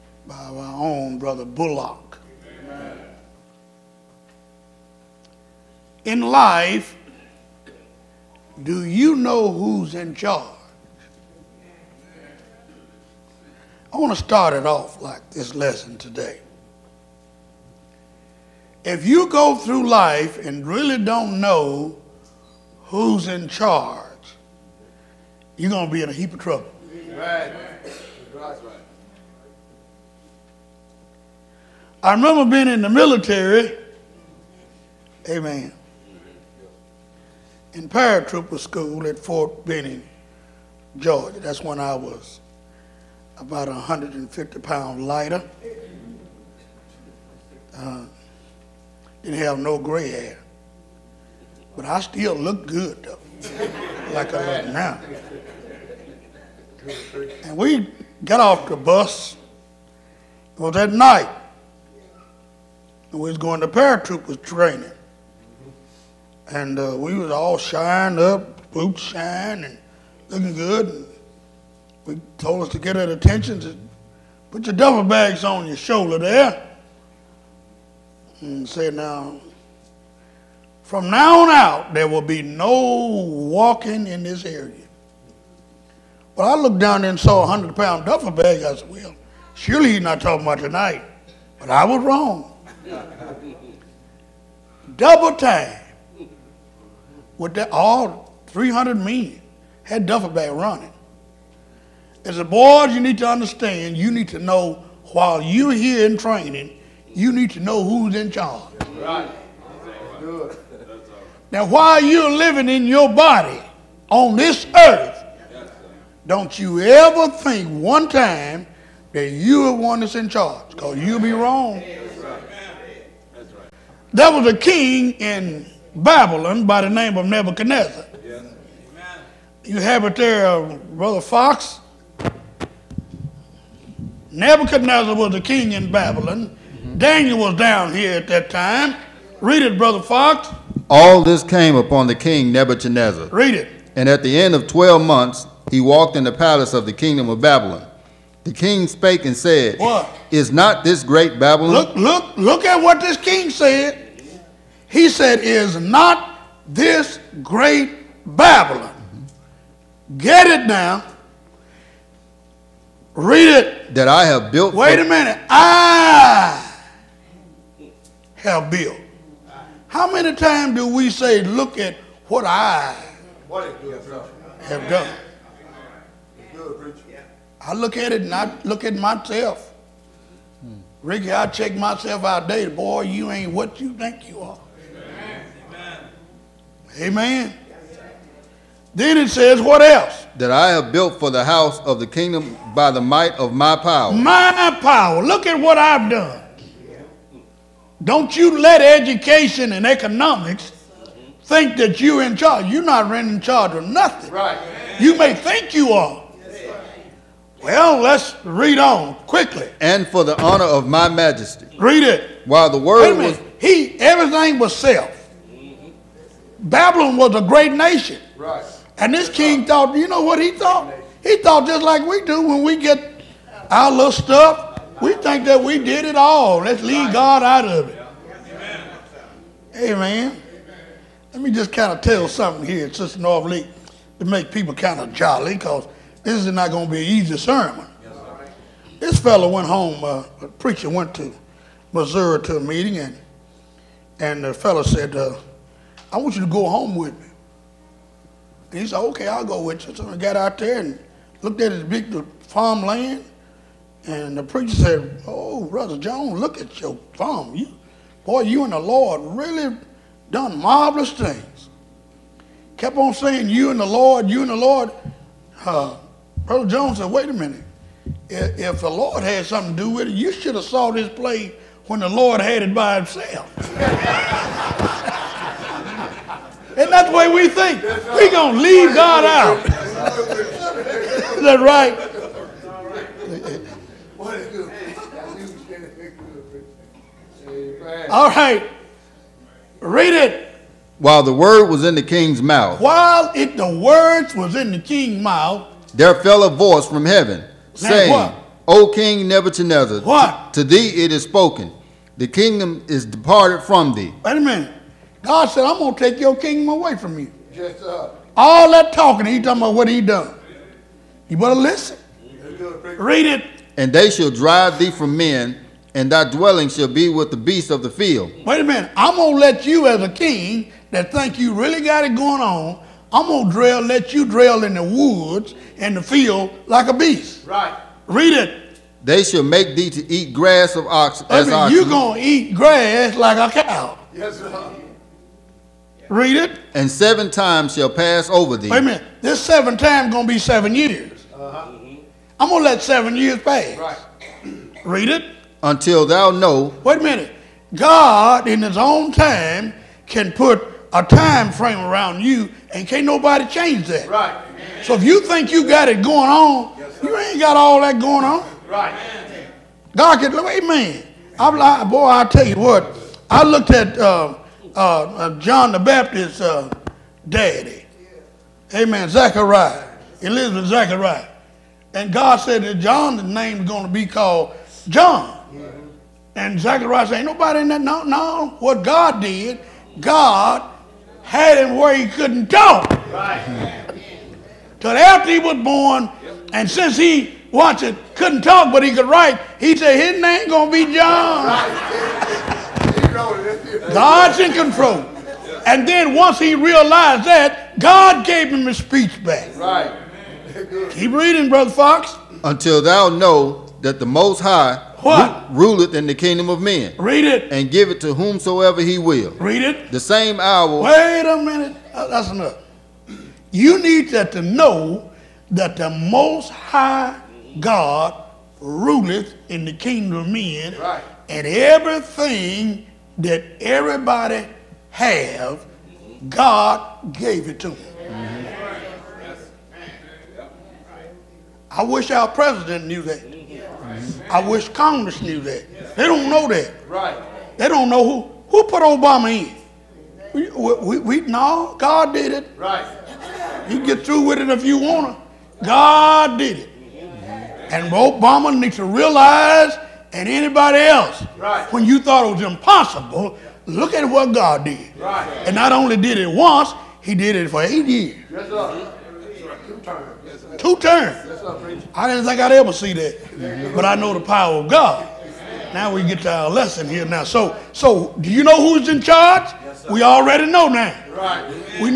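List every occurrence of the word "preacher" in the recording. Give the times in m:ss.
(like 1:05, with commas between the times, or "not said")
4:00, 4:14.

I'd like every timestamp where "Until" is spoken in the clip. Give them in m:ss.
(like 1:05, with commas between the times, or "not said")
5:45, 6:42.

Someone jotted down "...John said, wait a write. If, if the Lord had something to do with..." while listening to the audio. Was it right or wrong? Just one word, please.
wrong.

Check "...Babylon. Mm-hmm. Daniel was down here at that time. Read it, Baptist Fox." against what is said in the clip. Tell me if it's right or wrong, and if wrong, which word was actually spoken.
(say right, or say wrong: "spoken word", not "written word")
wrong: "Brother", not "Baptist".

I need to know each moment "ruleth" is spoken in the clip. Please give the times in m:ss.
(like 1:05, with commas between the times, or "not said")
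6:45, 6:58.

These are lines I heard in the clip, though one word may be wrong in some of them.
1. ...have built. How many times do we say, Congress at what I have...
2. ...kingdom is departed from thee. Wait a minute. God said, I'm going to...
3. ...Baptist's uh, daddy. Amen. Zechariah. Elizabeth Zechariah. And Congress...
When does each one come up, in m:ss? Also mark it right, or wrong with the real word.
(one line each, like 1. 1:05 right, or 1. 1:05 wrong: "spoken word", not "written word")
1. 2:48 wrong: "Look", not "Congress"
2. 5:02 right
3. 6:05 wrong: "God", not "Congress".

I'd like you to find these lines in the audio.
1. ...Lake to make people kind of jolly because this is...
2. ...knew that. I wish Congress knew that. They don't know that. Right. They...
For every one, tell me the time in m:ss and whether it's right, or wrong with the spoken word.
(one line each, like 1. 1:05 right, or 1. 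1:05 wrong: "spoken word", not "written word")
1. 3:53 right
2. 7:12 right.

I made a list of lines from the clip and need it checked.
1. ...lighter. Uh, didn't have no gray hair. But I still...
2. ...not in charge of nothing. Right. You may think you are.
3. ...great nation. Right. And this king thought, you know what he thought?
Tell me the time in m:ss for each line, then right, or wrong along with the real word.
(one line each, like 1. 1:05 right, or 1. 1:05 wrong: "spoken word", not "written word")
1. 0:45 right
2. 3:22 right
3. 3:37 right.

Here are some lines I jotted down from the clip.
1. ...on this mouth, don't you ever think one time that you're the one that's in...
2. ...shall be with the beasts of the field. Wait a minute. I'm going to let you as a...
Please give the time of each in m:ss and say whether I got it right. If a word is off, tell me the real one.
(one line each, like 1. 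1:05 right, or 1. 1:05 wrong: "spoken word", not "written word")
1. 1:54 wrong: "earth", not "mouth"
2. 5:16 right.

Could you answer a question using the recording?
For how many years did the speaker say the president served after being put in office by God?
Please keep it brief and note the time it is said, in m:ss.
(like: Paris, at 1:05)
8, at 7:37.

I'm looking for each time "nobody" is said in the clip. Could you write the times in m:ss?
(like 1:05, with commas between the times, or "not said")
5:53, 6:17.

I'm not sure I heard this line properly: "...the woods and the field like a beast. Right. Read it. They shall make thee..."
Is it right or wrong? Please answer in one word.
right.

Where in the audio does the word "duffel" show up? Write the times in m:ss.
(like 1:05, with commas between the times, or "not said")
1:14, 1:28, 1:40.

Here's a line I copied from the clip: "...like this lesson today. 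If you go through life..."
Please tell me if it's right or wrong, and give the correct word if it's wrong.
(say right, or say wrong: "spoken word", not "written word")
right.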